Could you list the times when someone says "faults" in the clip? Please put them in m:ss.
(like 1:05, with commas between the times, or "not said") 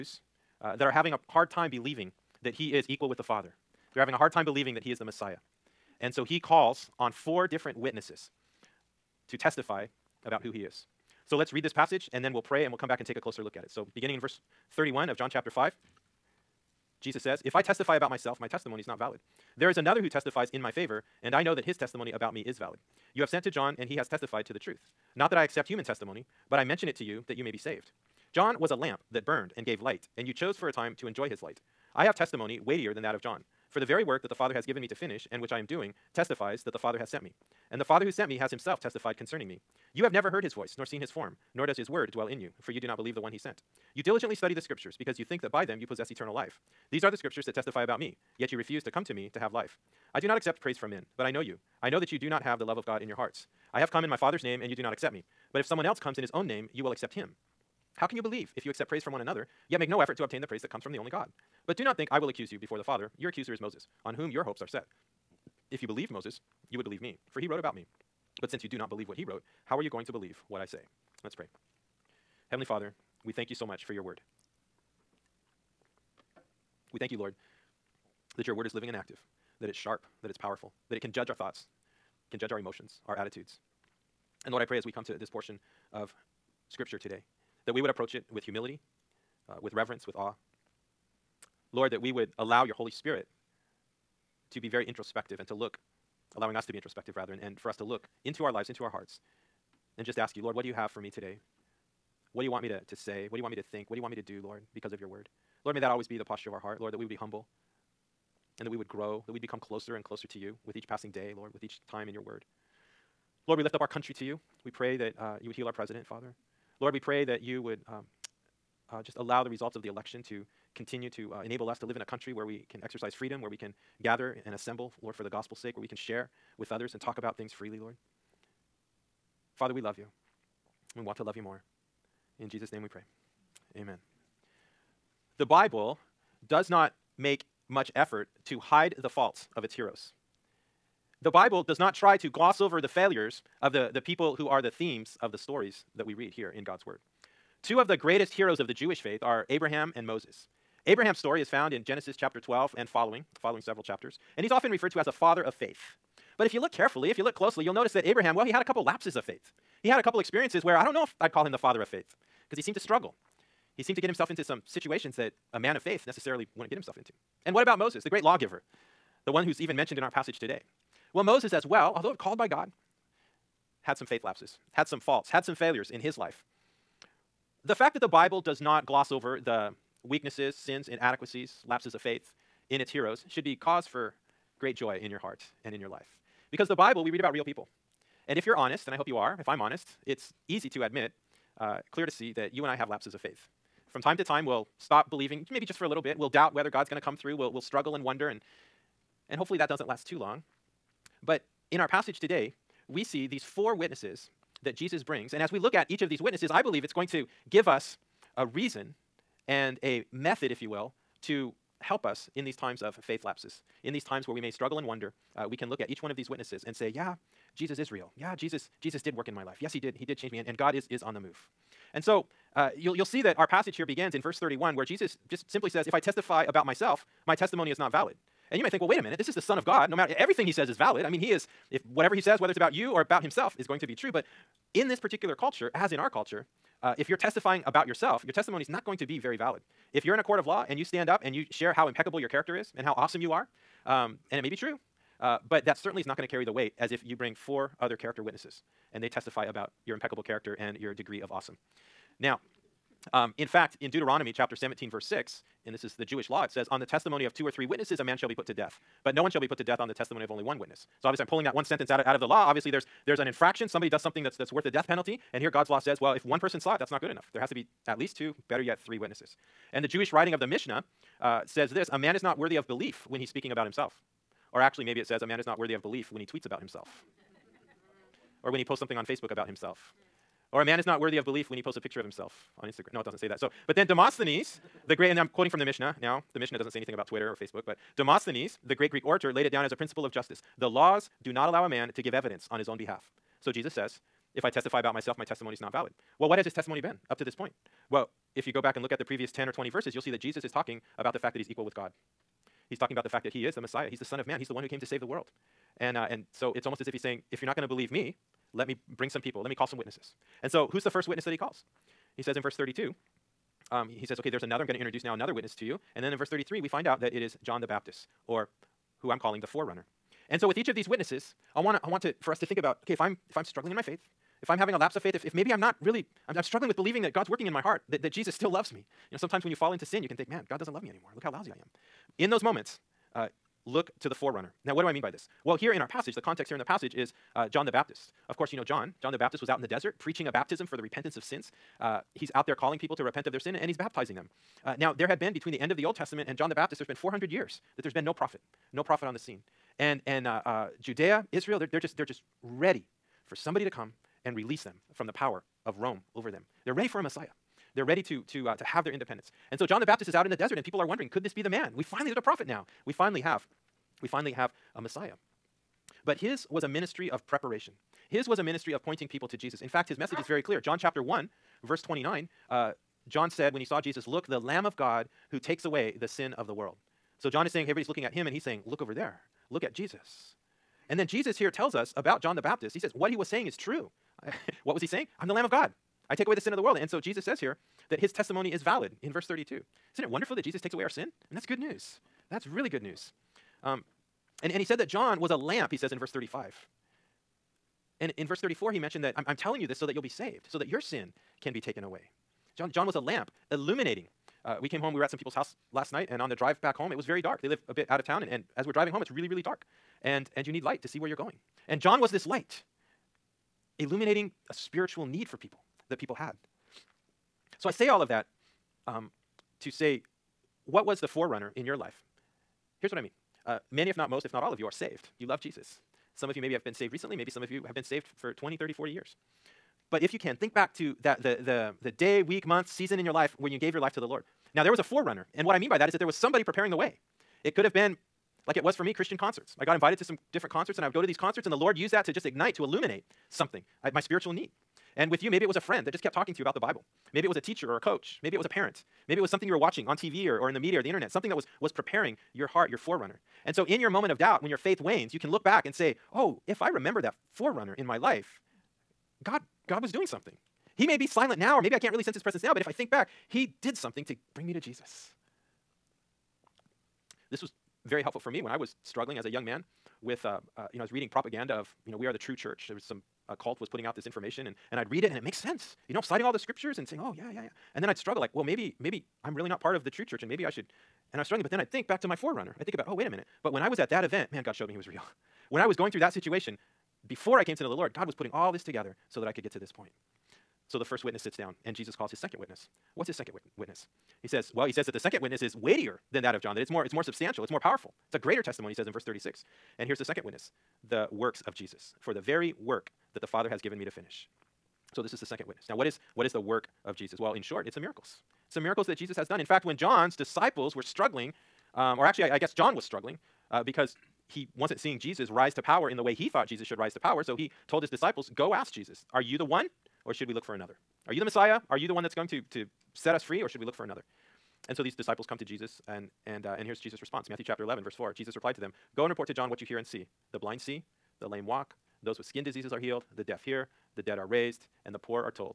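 2:19, 2:54.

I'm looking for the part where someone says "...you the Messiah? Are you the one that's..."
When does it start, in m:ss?
8:41.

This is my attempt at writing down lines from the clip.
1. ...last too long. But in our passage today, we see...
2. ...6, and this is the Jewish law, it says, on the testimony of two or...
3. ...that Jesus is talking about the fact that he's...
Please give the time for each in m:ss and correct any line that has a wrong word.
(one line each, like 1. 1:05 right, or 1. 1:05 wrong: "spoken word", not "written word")
1. 3:19 right
2. 4:15 right
3. 5:00 right.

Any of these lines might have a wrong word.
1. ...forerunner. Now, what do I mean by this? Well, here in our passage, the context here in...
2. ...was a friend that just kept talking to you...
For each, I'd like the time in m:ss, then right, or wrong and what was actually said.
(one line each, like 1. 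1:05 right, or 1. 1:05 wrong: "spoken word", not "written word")
1. 5:34 right
2. 7:25 right.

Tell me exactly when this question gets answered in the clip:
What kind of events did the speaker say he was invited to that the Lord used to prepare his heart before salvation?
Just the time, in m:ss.
7:18.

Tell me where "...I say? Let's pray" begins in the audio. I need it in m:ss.
1:10.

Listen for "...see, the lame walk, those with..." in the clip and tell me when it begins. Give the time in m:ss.
8:50.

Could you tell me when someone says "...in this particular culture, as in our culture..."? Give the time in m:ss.
3:54.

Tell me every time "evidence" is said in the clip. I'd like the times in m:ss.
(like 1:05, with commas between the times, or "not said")
4:52.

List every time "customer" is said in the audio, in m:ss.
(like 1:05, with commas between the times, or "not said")
not said.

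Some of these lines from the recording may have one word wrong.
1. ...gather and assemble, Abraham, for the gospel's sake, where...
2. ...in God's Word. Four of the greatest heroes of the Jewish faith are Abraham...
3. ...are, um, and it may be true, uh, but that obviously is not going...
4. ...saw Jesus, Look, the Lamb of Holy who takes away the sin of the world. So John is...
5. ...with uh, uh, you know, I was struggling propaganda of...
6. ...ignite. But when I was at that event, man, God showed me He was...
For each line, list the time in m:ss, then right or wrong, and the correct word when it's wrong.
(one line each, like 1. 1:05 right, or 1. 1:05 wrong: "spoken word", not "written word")
1. 2:04 wrong: "Lord", not "Abraham"
2. 2:26 wrong: "Two", not "Four"
3. 4:03 wrong: "certainly", not "obviously"
4. 6:13 wrong: "God", not "Holy"
5. 7:50 wrong: "reading", not "struggling"
6. 8:03 wrong: "minute", not "ignite".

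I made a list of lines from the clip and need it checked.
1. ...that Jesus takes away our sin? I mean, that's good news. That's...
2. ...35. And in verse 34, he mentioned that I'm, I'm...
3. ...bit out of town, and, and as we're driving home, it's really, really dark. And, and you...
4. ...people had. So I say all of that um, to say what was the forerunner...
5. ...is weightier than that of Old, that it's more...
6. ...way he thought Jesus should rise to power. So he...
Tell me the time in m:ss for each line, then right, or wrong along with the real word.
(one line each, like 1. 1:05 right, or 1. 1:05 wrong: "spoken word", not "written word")
1. 6:30 right
2. 6:36 right
3. 6:47 right
4. 6:55 right
5. 8:15 wrong: "John", not "Old"
6. 8:36 right.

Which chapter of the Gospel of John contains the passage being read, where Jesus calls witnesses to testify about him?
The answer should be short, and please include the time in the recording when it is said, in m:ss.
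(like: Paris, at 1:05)
Chapter 5, at 0:15.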